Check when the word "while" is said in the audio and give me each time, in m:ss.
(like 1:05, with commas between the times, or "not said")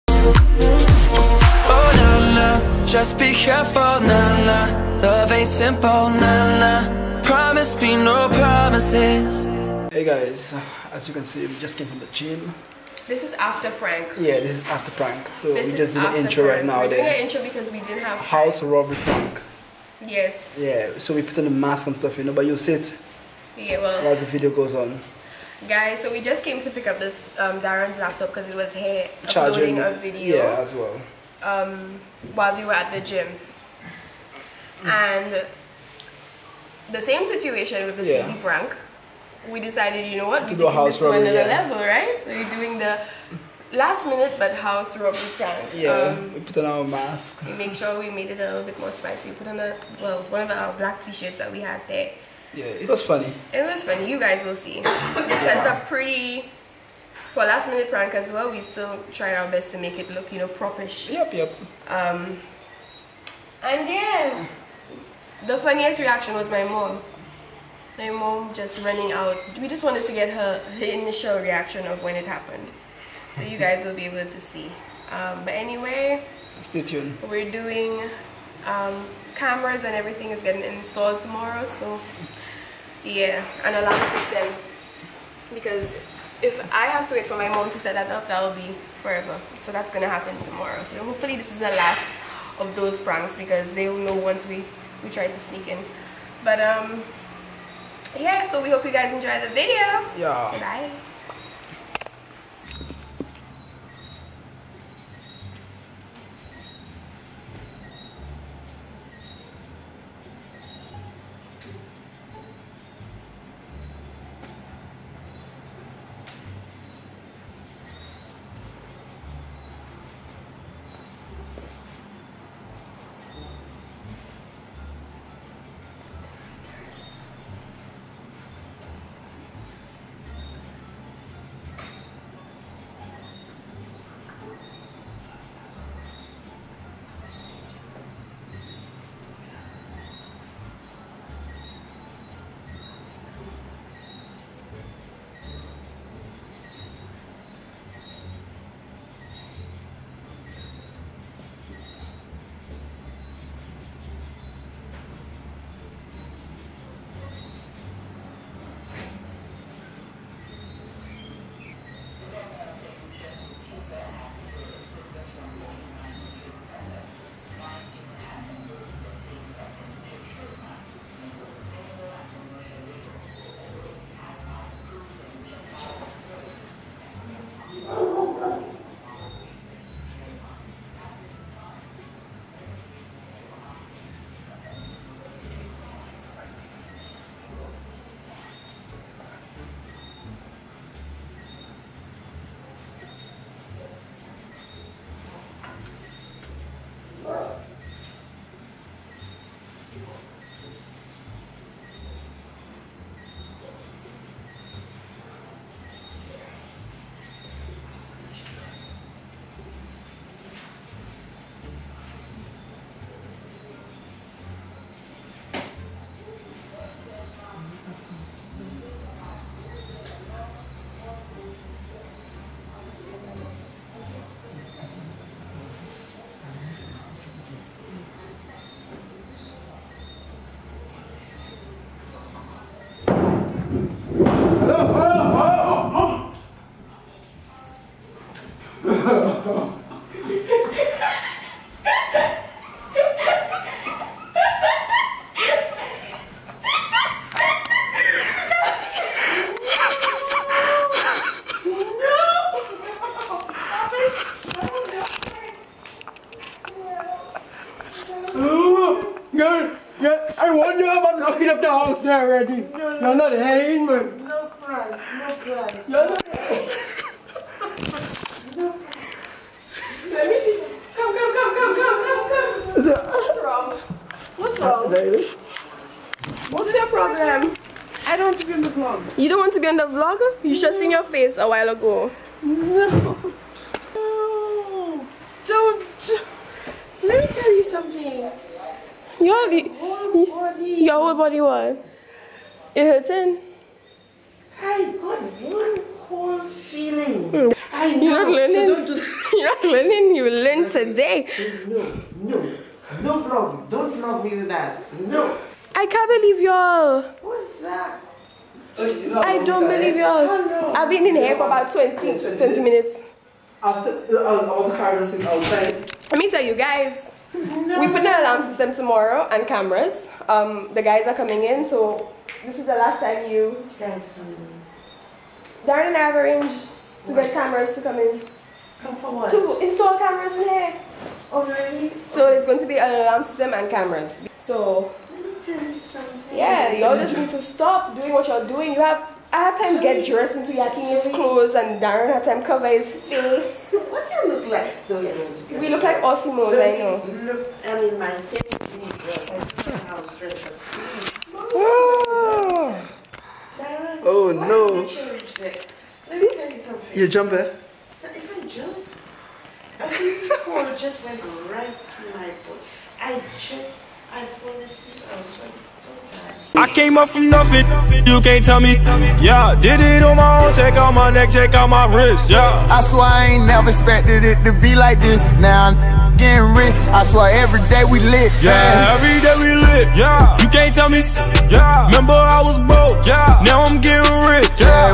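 0:32, 4:41.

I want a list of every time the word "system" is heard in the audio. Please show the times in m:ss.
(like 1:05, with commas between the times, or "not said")
1:24, 5:18, 5:33.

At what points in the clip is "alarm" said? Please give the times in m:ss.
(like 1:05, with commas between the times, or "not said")
1:23, 5:18, 5:33.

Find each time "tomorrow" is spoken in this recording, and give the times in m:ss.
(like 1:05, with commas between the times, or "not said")
1:21, 1:30, 5:18.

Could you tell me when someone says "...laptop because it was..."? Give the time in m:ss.
0:27.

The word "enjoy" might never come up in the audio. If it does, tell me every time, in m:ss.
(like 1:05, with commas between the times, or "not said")
1:39.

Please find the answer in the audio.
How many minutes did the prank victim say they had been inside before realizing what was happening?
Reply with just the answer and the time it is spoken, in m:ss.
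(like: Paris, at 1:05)
20, at 5:12.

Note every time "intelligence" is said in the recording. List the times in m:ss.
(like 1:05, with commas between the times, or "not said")
not said.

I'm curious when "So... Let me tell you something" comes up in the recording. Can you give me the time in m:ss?
5:34.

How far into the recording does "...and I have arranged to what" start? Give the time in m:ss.
5:25.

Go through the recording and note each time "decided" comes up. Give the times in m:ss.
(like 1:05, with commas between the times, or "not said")
0:39.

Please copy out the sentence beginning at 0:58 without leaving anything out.
We still try our best to make it look, you know, propish.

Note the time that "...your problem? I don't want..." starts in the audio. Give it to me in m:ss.
4:36.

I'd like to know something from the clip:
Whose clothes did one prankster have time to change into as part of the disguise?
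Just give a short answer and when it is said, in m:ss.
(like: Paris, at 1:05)
Yakini's, at 5:40.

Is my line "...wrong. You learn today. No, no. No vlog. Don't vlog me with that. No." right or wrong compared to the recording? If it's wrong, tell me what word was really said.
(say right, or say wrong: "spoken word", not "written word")
wrong: "learning", not "wrong".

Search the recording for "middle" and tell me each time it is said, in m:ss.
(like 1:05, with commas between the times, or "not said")
not said.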